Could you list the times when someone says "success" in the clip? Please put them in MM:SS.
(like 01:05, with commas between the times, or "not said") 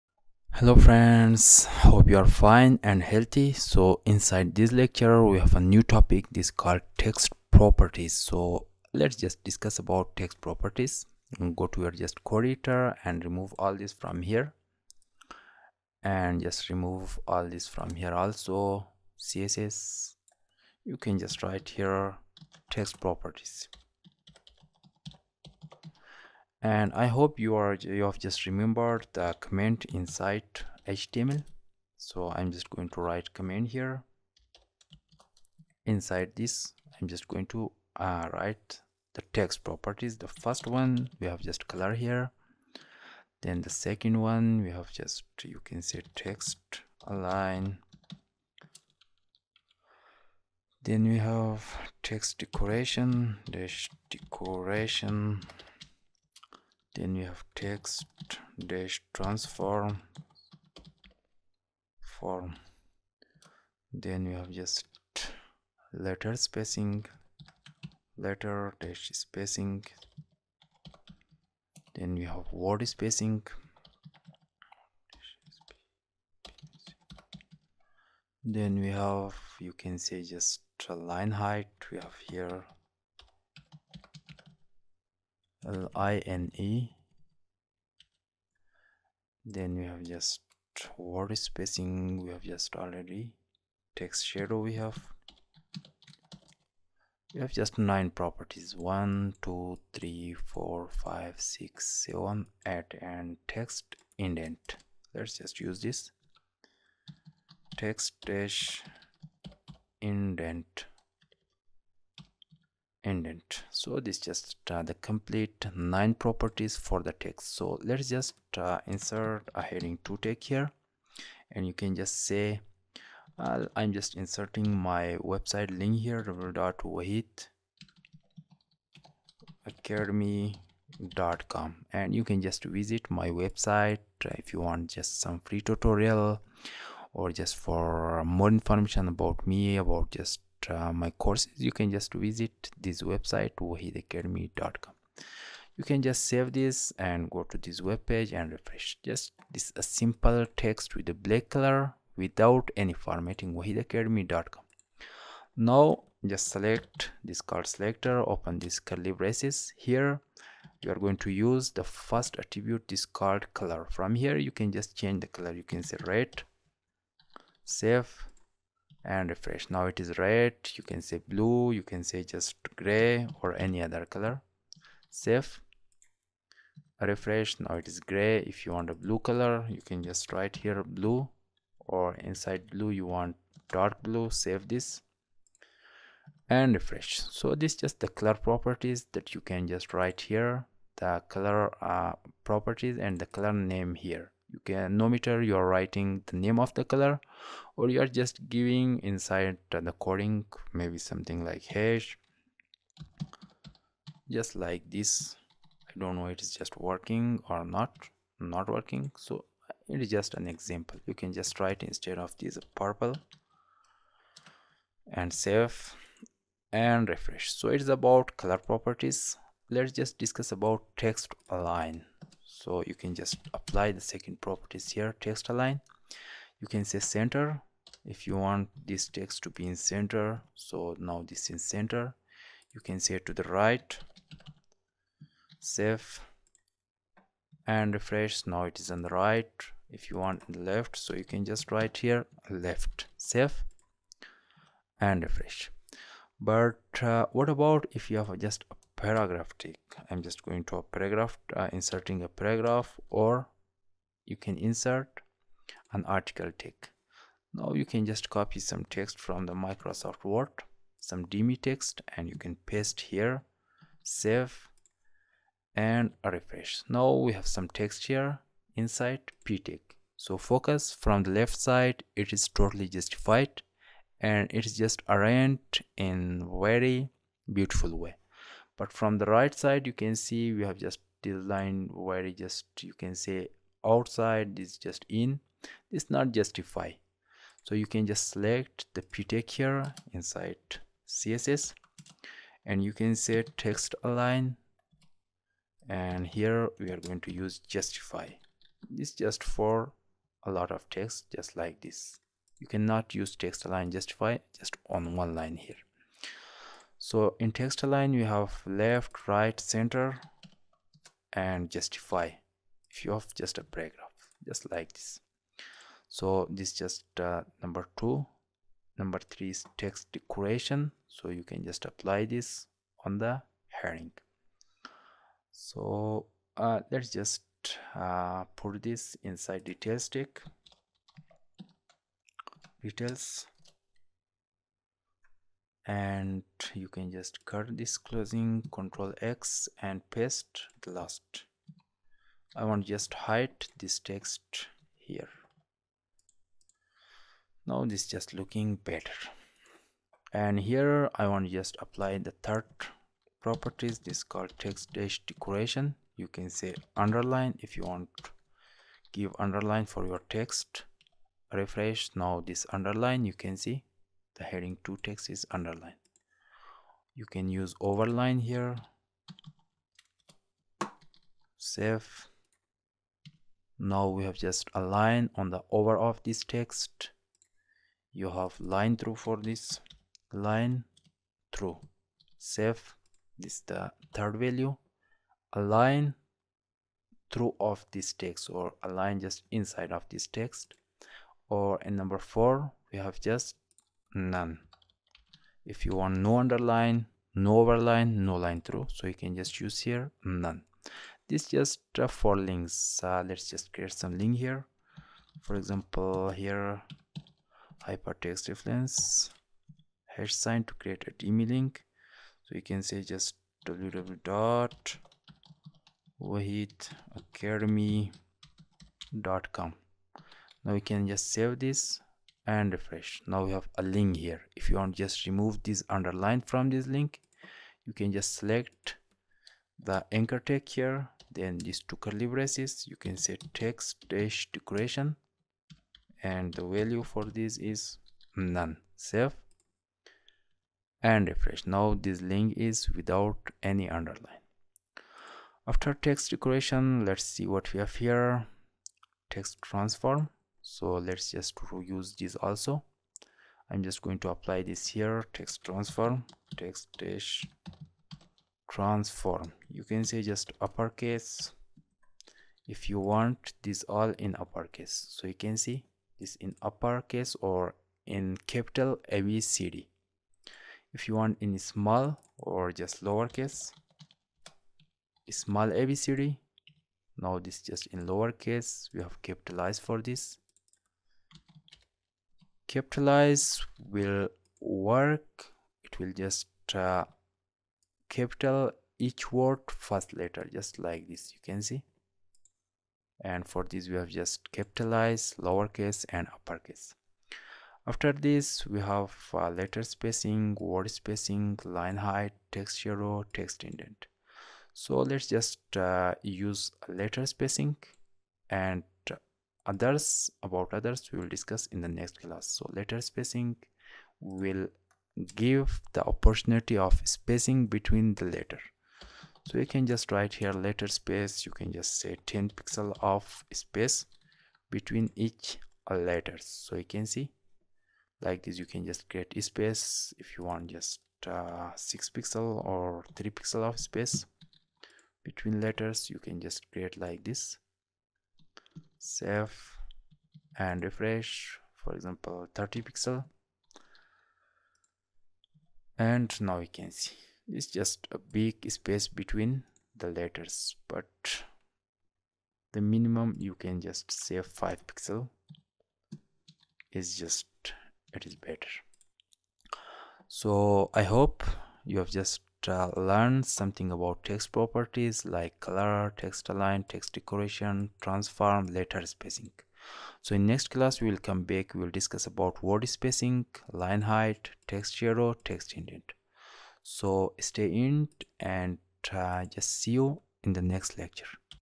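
not said.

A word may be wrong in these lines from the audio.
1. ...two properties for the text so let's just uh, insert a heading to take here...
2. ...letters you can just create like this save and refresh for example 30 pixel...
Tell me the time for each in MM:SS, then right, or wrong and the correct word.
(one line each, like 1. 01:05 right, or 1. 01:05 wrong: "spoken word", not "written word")
1. 01:55 wrong: "nine", not "two"
2. 08:55 right.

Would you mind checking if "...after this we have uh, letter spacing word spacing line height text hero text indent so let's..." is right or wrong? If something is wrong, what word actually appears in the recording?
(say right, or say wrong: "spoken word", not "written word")
right.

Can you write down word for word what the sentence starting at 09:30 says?
So in next class, we will come back, we will discuss about word spacing, line height, text shadow, text indent.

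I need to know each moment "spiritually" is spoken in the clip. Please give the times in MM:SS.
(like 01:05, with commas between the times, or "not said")
not said.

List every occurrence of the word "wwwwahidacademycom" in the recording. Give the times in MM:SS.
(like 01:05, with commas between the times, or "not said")
02:06.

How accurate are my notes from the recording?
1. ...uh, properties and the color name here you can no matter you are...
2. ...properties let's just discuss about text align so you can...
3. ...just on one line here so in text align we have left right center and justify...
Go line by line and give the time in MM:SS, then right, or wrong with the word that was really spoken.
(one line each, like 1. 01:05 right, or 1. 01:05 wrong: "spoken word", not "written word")
1. 03:11 right
2. 03:38 right
3. 05:04 right.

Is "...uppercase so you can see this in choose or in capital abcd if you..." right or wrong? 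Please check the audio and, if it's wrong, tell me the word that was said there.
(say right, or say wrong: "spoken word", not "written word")
wrong: "uppercase", not "choose".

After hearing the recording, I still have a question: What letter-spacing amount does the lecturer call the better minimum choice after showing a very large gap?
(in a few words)
5 pixels.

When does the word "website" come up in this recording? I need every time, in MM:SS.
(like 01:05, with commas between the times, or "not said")
02:05, 02:13, 02:23.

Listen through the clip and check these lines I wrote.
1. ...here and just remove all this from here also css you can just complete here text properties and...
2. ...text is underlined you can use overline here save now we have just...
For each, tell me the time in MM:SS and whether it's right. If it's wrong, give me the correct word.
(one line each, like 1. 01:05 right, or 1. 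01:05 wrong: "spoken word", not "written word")
1. 00:14 wrong: "write", not "complete"
2. 06:05 right.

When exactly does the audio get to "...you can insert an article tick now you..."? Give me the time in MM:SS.
04:14.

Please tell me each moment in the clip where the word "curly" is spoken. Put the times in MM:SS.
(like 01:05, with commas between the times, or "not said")
02:38, 07:11.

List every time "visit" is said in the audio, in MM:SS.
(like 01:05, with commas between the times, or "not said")
02:12, 02:22.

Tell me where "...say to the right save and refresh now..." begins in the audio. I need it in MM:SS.
03:53.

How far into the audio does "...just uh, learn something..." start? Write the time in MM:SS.
09:22.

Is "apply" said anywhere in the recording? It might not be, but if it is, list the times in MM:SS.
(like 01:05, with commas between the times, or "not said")
03:43, 05:21, 05:51, 07:34.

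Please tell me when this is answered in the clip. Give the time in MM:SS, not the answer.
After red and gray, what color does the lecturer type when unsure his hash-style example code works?
03:32.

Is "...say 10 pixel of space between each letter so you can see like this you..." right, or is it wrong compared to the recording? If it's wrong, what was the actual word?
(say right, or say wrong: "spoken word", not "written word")
right.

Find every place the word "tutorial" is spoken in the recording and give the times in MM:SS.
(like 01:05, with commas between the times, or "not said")
02:15.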